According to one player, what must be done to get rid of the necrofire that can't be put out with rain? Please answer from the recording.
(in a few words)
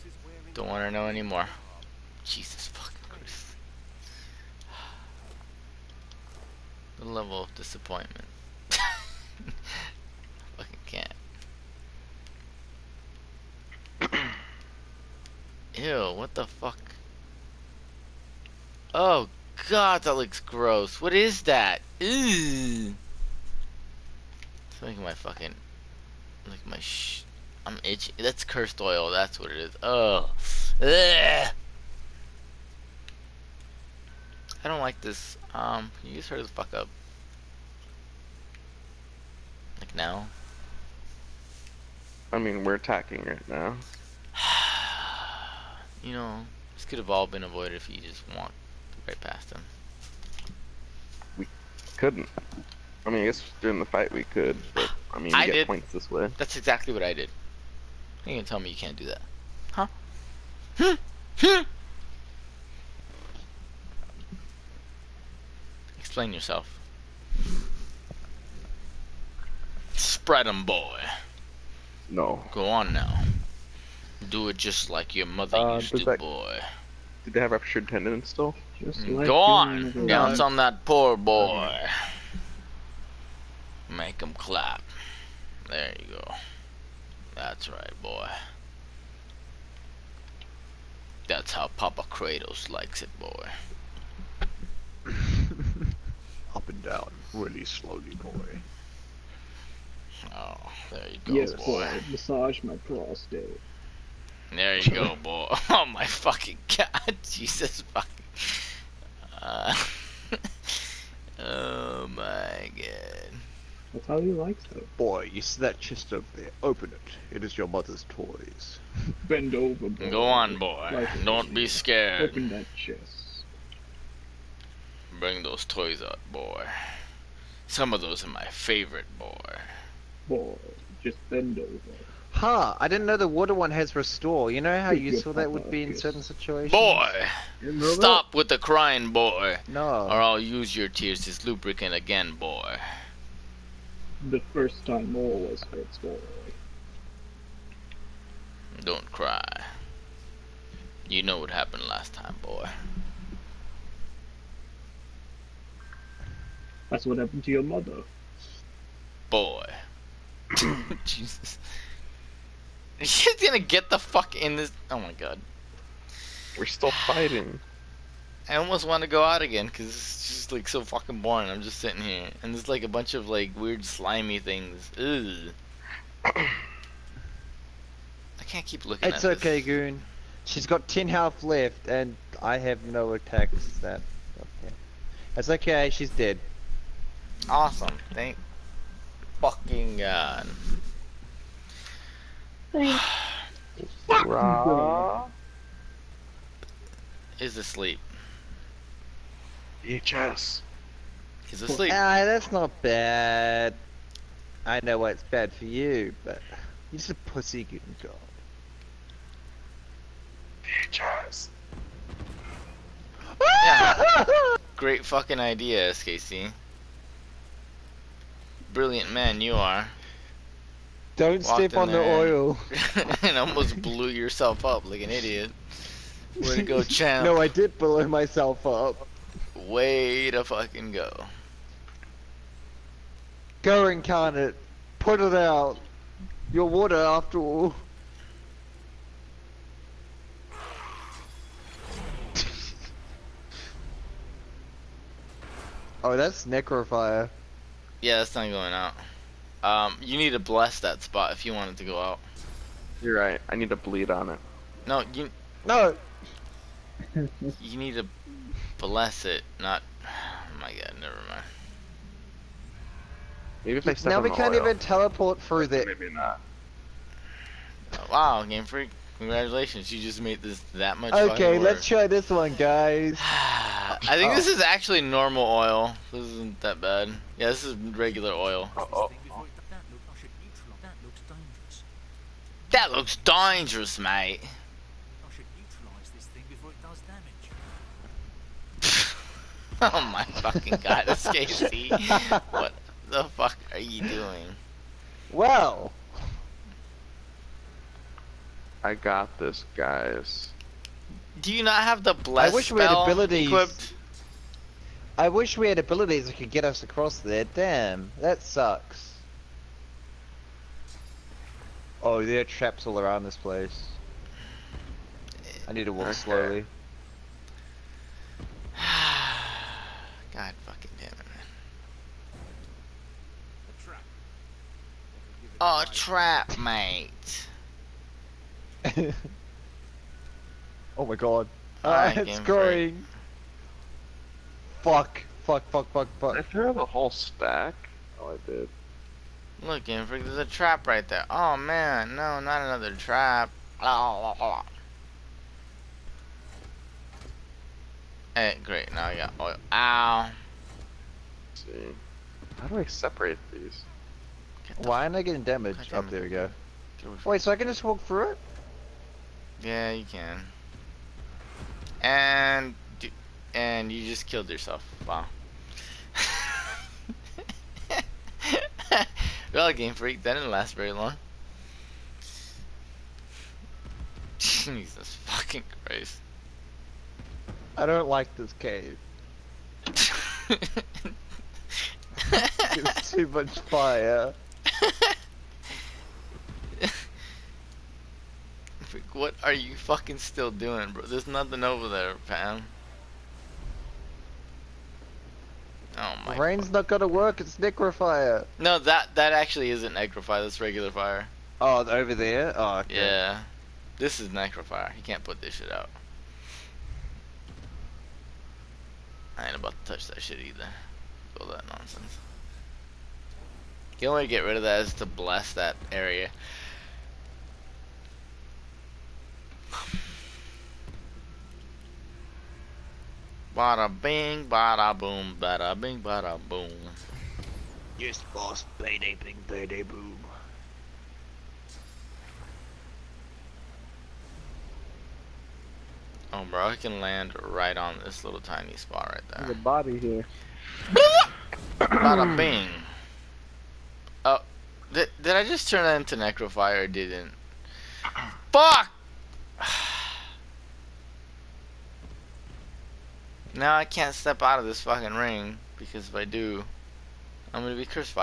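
blast that area.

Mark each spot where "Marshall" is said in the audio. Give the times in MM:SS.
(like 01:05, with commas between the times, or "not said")
not said.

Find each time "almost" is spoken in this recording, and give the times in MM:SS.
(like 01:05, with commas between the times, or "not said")
02:48, 03:43.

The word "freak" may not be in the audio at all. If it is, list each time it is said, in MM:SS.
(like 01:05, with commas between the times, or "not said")
04:28, 05:39, 06:09.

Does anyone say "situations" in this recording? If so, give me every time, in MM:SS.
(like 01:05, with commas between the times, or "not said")
02:16.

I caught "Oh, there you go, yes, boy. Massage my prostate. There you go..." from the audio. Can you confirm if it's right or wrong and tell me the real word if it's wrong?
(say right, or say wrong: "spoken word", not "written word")
right.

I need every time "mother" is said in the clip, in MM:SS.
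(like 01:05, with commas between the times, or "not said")
01:15, 01:57, 02:37.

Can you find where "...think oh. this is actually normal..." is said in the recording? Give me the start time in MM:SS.
04:34.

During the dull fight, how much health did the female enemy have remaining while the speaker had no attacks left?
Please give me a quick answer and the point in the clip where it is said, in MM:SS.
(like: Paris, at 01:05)
10, at 03:00.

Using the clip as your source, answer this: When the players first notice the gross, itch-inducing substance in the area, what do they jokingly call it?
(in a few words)
cursed oil.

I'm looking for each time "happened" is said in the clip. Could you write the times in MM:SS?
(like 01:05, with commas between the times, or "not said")
02:31, 02:37.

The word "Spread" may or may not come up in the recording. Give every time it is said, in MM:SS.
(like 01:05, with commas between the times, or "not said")
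01:09.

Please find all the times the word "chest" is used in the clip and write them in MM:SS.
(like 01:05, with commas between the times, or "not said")
01:55, 02:02.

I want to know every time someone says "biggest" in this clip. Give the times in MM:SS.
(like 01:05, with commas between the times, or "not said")
not said.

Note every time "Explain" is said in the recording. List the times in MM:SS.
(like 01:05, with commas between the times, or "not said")
01:06.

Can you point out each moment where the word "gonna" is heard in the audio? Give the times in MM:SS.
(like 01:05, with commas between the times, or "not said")
02:43, 06:36, 07:37.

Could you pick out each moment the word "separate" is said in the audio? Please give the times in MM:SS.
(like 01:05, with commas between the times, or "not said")
05:52.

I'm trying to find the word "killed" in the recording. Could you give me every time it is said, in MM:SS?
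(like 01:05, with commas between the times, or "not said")
06:04.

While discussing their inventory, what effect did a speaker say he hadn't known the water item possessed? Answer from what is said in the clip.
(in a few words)
restore.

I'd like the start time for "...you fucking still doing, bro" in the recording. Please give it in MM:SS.
06:29.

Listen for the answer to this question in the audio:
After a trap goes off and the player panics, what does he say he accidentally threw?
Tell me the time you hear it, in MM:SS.
05:36.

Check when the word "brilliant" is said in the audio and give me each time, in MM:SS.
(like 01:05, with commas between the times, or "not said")
03:38.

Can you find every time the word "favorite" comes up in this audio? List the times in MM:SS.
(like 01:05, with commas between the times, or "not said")
02:08.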